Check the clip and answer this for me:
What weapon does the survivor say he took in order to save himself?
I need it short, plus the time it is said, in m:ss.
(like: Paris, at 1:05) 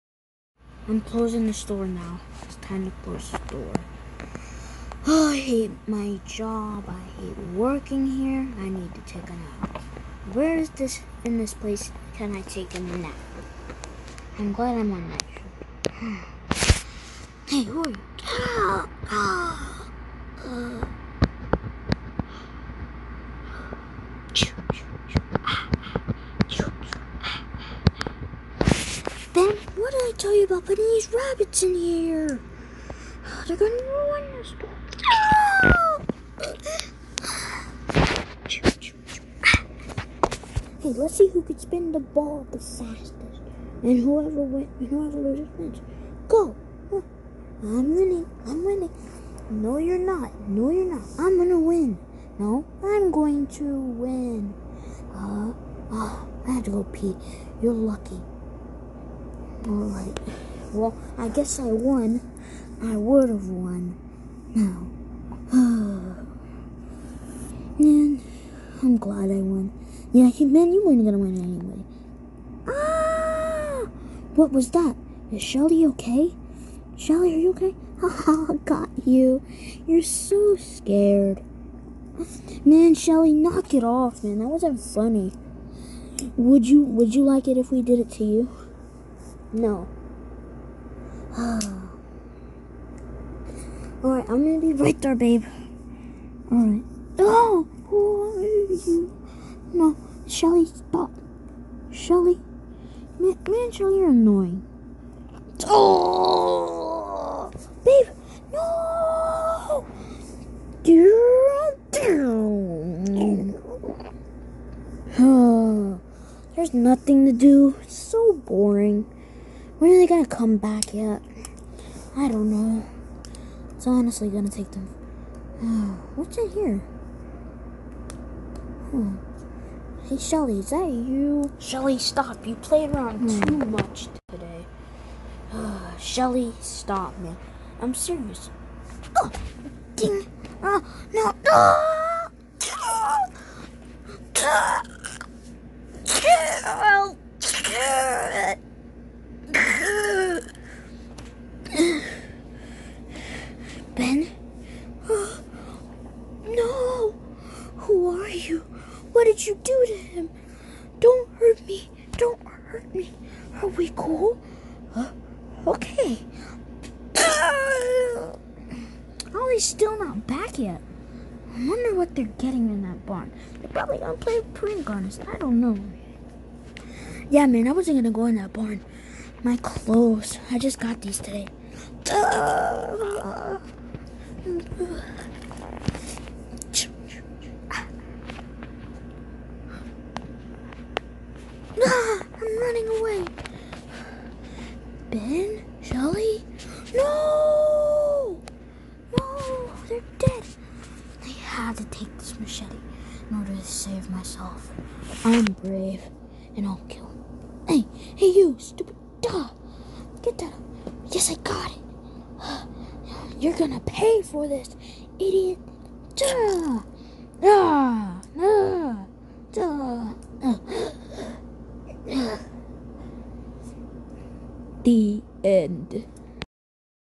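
Machete, at 3:22.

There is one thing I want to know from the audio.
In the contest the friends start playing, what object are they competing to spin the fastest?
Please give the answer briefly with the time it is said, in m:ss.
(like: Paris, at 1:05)
The ball, at 0:41.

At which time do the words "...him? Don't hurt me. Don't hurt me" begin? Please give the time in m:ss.
2:39.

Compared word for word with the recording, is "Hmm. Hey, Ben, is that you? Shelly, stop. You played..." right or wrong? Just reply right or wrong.
wrong.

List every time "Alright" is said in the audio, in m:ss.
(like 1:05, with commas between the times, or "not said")
0:59, 1:31, 1:36.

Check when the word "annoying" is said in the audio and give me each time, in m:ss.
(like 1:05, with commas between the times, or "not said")
1:44.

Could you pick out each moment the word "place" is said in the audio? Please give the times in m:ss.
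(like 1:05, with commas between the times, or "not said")
0:11.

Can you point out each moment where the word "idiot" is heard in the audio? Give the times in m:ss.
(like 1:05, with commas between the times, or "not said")
3:35.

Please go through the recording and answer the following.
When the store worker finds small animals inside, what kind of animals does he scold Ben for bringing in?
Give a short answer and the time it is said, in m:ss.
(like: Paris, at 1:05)
Rabbits, at 0:31.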